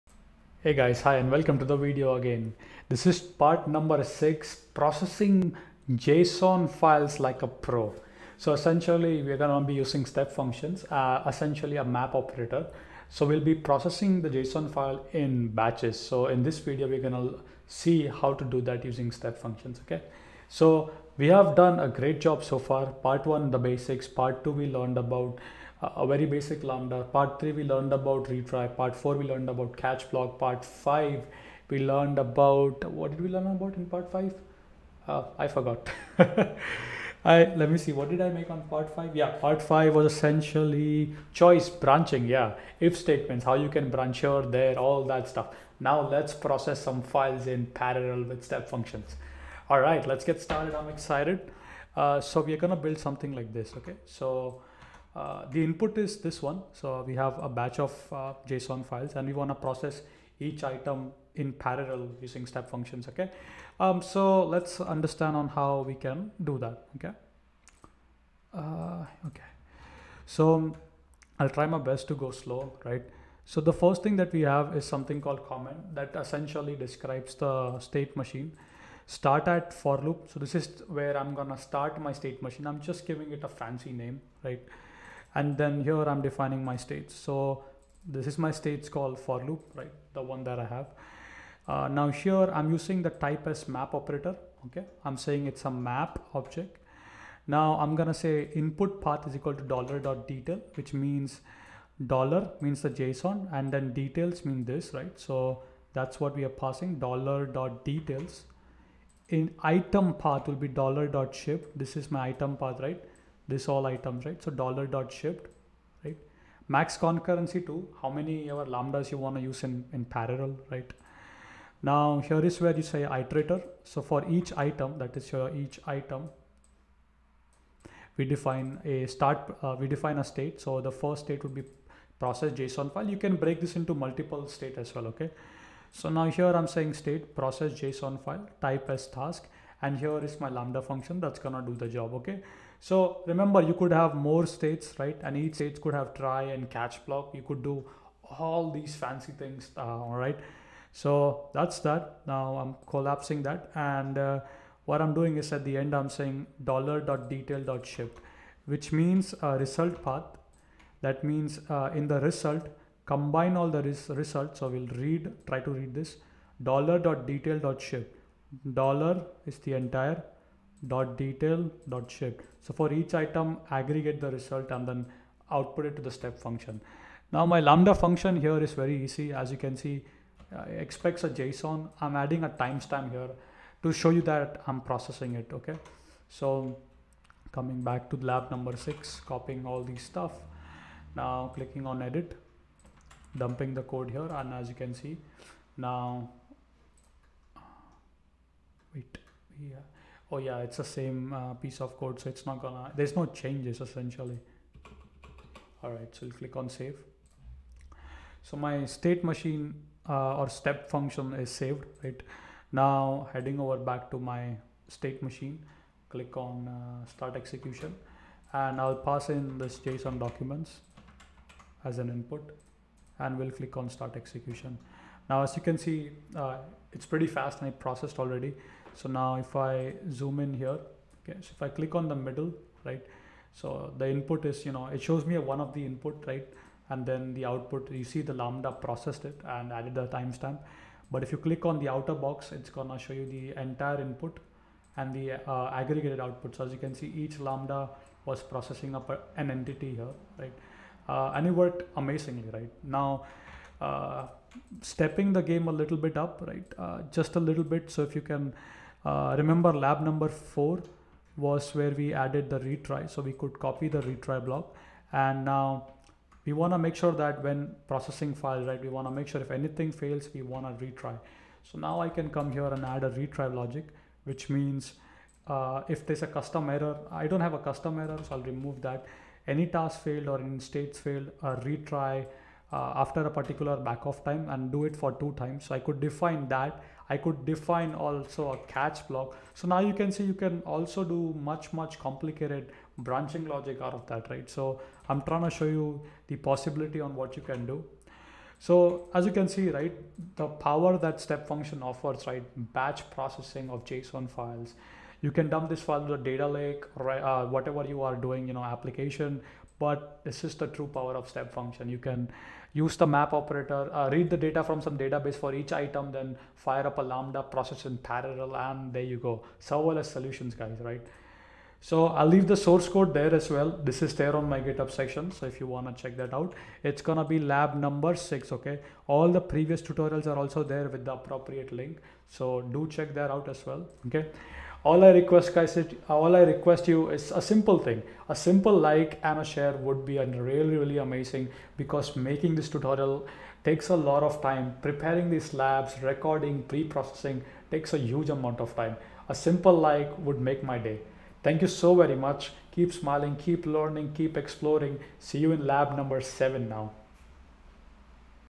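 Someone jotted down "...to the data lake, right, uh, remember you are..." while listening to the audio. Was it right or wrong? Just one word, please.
wrong.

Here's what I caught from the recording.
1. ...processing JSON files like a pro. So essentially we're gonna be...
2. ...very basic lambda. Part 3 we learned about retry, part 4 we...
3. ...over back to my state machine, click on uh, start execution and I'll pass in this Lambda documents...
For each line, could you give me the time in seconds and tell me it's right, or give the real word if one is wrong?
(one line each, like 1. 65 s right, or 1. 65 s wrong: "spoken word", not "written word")
1. 4 s right
2. 26 s right
3. 213 s wrong: "JSON", not "Lambda".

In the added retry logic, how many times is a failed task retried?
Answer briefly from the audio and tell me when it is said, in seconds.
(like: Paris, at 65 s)
2, at 285 s.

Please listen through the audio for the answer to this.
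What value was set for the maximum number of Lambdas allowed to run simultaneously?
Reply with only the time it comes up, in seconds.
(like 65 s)
116 s.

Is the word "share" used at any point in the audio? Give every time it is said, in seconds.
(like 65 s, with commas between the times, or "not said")
339 s.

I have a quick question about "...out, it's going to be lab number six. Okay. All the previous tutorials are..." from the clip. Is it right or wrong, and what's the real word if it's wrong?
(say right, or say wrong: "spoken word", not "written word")
right.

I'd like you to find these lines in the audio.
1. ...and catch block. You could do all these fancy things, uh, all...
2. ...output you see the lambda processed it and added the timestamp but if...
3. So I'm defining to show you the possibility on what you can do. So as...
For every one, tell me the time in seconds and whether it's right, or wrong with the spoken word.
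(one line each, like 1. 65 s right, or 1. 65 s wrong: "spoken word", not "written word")
1. 146 s right
2. 237 s right
3. 294 s wrong: "trying", not "defining".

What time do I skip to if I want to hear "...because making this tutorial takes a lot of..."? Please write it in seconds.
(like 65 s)
341 s.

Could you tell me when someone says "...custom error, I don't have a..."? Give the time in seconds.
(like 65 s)
276 s.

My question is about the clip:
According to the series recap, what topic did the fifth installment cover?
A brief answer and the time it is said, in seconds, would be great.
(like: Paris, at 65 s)
Choice branching, at 41 s.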